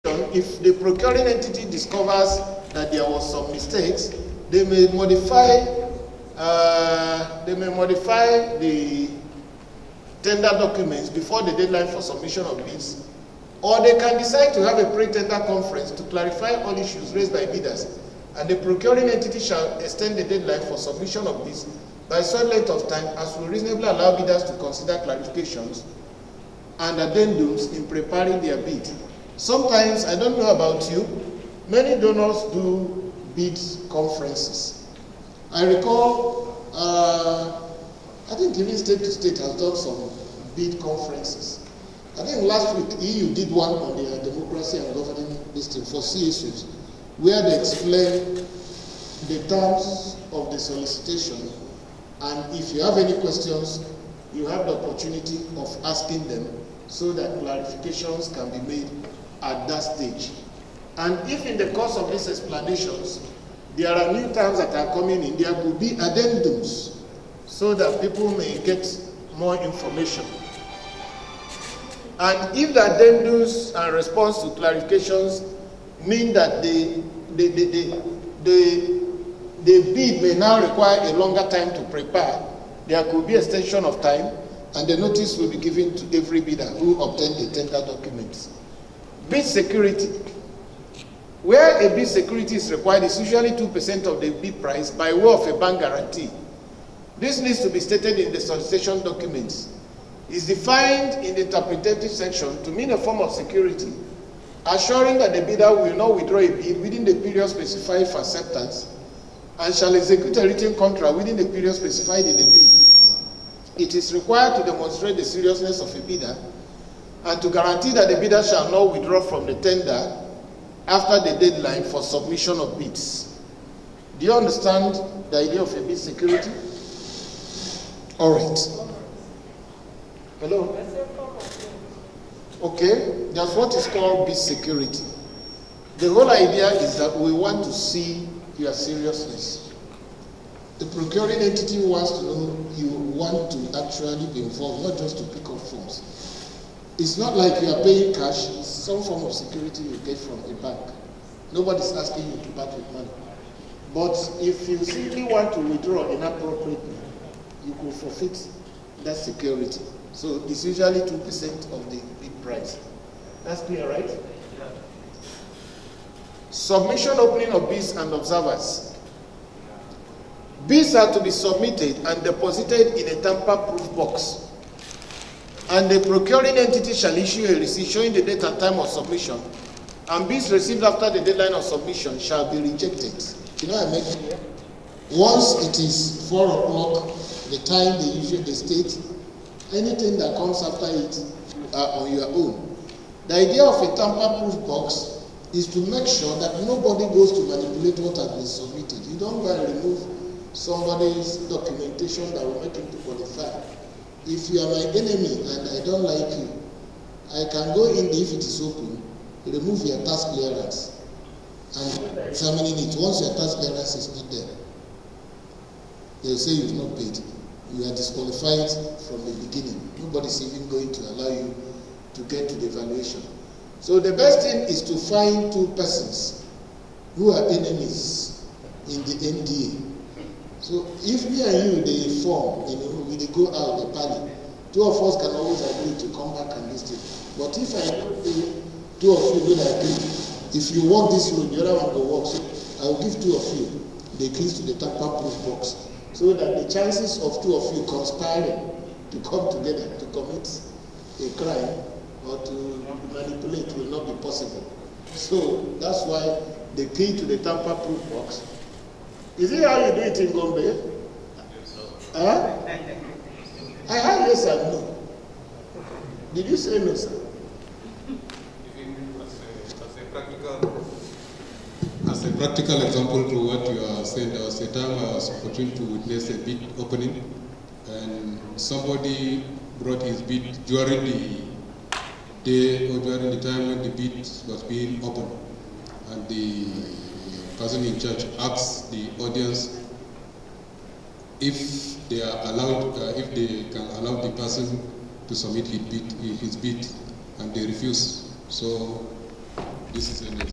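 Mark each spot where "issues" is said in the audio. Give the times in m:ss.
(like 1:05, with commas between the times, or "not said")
0:16, 2:57.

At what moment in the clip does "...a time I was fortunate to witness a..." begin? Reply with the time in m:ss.
4:34.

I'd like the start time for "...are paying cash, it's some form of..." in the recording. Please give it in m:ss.
2:27.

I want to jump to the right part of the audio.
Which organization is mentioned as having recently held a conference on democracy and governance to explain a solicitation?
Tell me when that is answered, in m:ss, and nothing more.
0:43.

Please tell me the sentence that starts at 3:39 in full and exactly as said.
Nobody's even going to allow you to get to the evaluation.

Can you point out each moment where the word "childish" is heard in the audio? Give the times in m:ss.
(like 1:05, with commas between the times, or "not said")
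not said.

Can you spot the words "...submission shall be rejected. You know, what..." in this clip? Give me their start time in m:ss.
3:01.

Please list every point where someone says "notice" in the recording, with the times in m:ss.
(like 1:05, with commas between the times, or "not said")
1:24.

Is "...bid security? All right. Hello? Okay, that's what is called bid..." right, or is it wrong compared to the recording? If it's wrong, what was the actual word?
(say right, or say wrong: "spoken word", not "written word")
right.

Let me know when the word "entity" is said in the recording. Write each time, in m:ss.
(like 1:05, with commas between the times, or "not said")
0:01, 0:19, 2:21, 2:56.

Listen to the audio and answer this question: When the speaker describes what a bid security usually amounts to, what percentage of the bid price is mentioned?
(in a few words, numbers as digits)
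2%.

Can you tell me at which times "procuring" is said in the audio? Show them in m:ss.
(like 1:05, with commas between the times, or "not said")
0:00, 0:18, 2:20, 2:56.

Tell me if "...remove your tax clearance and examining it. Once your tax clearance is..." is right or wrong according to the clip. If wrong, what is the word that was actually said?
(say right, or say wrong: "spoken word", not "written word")
right.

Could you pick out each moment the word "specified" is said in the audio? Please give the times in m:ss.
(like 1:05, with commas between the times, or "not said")
1:47, 1:51.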